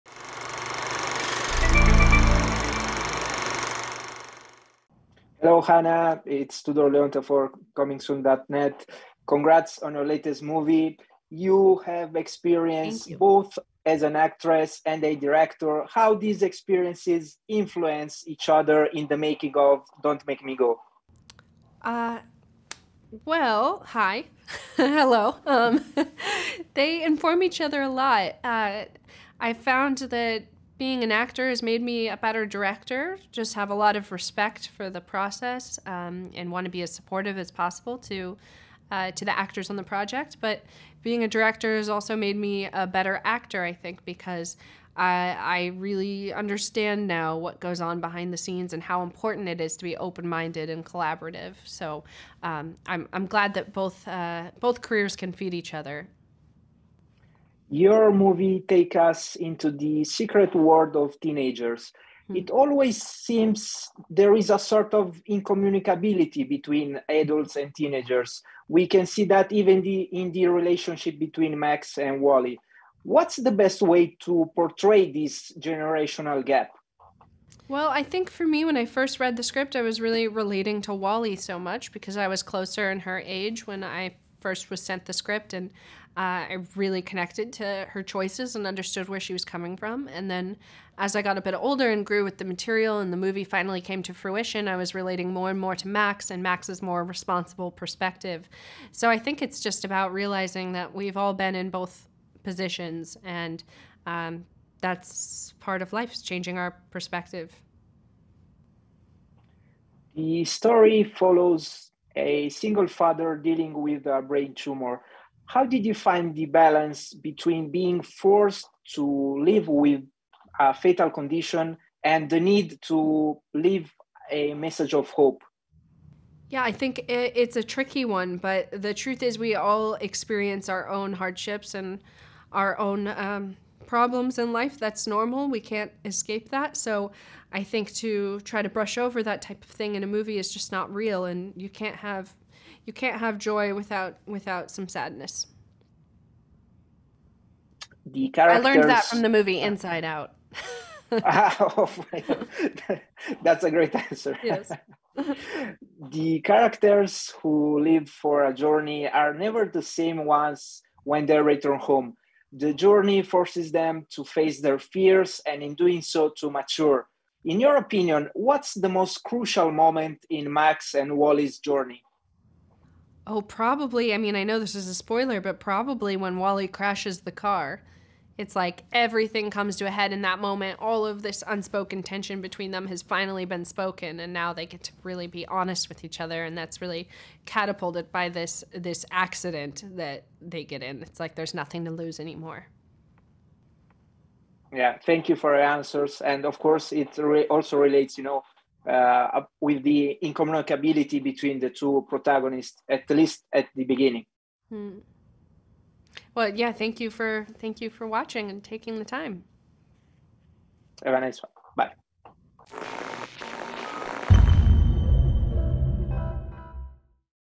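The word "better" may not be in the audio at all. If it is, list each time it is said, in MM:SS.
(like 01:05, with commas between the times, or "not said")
00:32, 00:42.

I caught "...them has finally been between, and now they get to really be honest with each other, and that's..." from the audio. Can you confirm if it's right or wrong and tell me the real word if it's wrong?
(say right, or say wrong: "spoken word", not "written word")
wrong: "spoken", not "between".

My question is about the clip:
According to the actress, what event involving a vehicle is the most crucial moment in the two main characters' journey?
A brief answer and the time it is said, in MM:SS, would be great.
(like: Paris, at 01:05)
Wally crashes the car, at 02:56.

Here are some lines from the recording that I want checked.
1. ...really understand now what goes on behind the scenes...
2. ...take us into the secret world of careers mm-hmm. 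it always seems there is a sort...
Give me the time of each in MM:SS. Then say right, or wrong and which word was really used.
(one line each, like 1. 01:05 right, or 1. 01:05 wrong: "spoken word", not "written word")
1. 00:45 right
2. 00:58 wrong: "teenagers", not "careers".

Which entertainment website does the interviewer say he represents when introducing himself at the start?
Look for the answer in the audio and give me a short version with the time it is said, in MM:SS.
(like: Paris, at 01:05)
comingsoon.net, at 00:07.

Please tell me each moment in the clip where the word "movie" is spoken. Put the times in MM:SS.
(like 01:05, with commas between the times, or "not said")
00:10, 00:58, 01:33, 02:20, 02:29.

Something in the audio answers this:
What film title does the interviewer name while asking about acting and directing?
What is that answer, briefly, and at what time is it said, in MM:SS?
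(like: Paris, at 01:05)
Don't Make Me Go, at 00:20.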